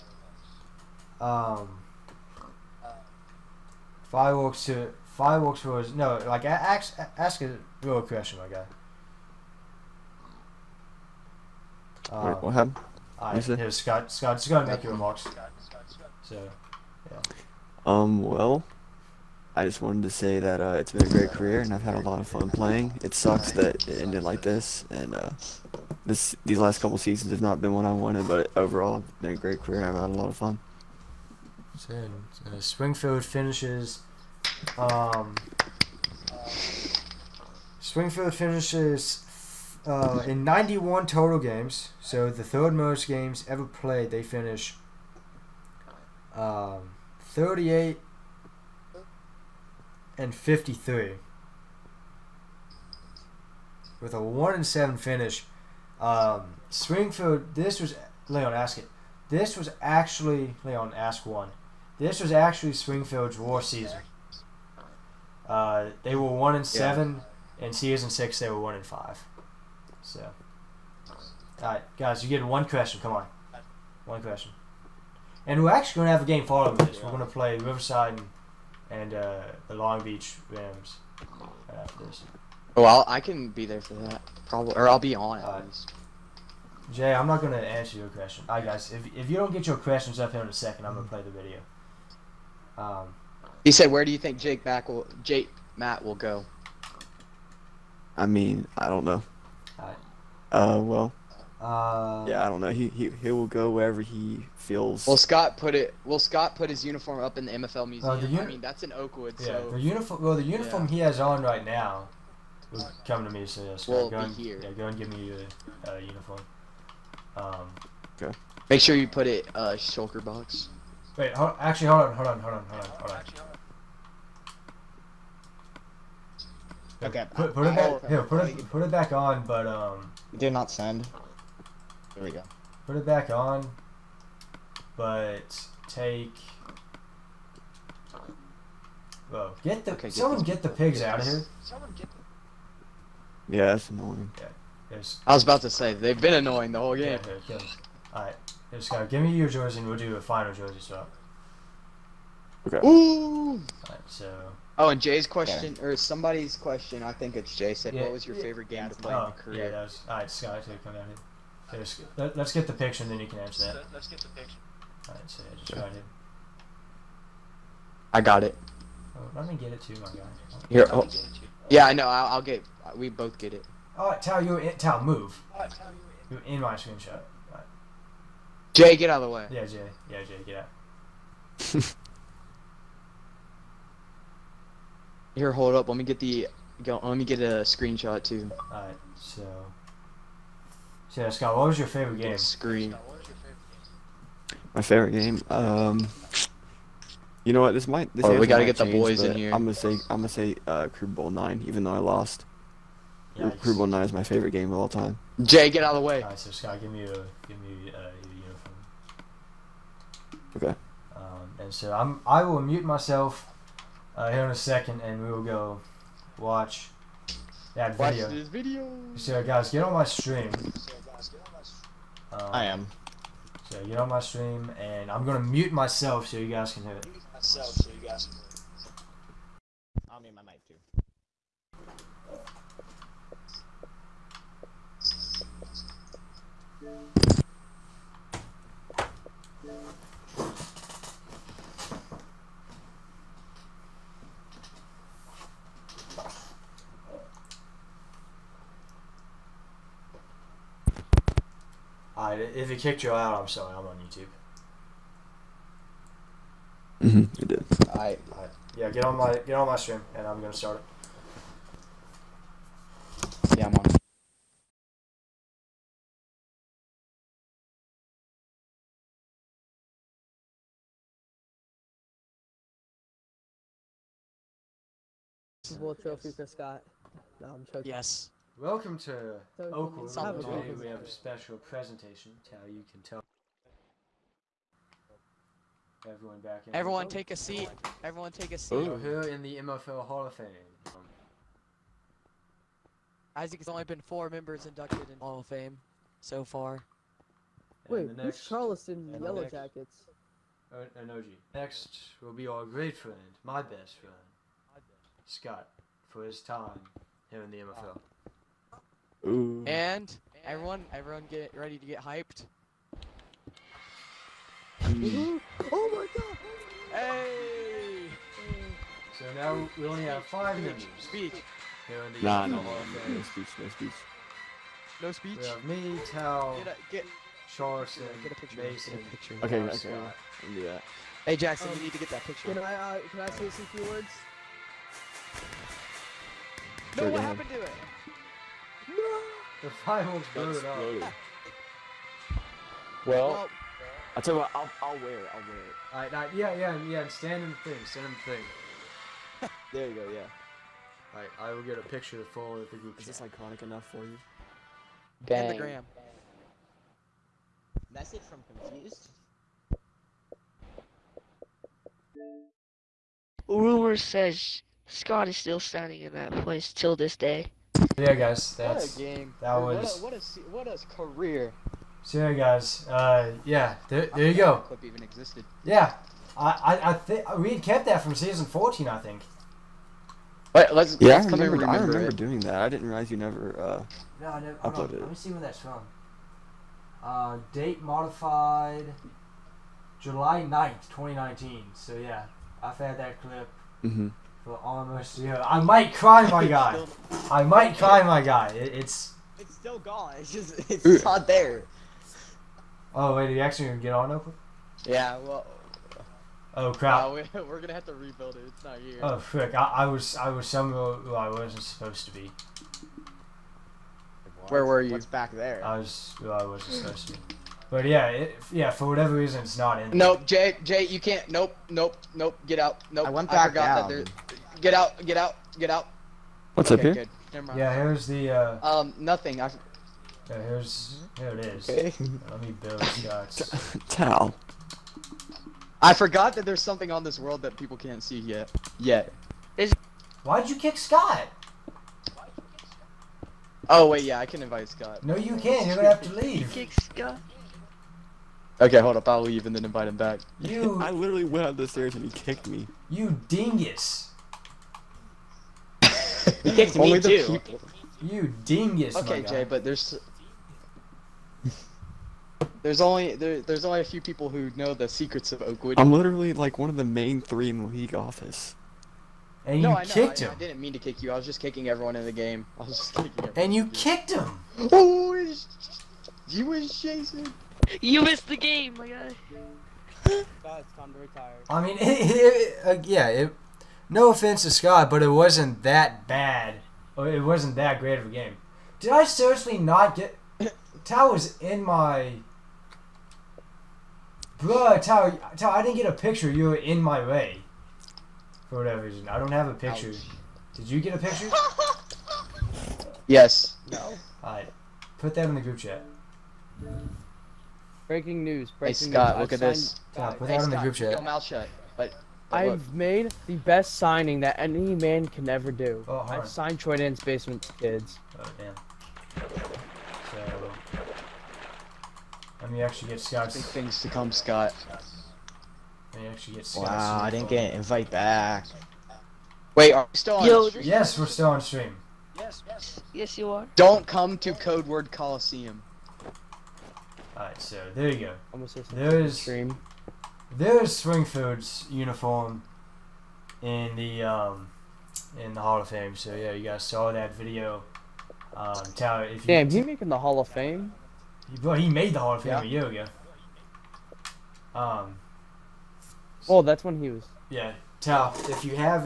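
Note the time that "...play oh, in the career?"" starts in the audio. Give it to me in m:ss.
2:38.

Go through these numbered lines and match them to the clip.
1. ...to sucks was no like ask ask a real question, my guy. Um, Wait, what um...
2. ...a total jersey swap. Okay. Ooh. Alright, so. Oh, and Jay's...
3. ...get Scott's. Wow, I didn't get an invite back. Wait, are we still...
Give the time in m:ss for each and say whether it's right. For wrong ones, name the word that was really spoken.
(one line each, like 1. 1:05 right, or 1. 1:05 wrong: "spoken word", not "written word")
1. 0:04 wrong: "fireworks", not "sucks"
2. 2:30 wrong: "final", not "total"
3. 8:46 right.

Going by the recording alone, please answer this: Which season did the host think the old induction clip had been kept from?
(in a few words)
Season 14.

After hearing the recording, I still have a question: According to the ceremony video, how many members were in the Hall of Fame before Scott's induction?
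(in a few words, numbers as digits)
4.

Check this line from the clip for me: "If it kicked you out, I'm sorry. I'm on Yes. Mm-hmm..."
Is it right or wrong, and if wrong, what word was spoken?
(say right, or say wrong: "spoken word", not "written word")
wrong: "YouTube", not "Yes".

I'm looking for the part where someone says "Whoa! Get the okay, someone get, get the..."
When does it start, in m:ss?
2:19.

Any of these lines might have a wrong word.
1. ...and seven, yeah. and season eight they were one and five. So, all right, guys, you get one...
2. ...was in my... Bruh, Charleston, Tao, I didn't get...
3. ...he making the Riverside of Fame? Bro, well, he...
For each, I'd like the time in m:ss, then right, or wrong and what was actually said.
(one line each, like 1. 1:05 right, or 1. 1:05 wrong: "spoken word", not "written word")
1. 1:06 wrong: "six", not "eight"
2. 8:11 wrong: "Tao", not "Charleston"
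3. 9:09 wrong: "Hall", not "Riverside".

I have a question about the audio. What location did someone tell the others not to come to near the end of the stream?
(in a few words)
Code Word Coliseum.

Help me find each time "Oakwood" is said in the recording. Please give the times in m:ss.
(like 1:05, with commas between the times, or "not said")
1:48, 4:39, 7:45.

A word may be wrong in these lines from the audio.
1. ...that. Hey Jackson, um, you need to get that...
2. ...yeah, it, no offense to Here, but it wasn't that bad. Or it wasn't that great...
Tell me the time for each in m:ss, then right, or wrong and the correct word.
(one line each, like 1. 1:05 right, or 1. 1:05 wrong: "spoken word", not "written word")
1. 5:30 right
2. 8:02 wrong: "Scott", not "Here".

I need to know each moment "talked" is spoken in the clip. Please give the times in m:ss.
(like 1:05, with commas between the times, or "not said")
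not said.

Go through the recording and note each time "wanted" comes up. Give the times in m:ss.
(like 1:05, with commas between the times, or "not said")
0:19, 0:27.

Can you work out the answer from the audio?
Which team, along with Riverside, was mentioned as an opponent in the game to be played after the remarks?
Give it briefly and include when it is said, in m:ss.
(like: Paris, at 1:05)
Long Beach Rams, at 1:19.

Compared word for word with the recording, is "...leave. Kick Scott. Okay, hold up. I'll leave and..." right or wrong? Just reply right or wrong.
right.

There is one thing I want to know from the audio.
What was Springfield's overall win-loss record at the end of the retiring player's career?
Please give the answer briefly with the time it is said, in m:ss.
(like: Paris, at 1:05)
38 and 53, at 0:47.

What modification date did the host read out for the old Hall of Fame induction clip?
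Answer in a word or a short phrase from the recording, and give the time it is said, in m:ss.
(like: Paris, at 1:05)
July 9th, 2019, at 6:30.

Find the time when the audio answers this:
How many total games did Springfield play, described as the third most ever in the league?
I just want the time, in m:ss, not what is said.
0:40.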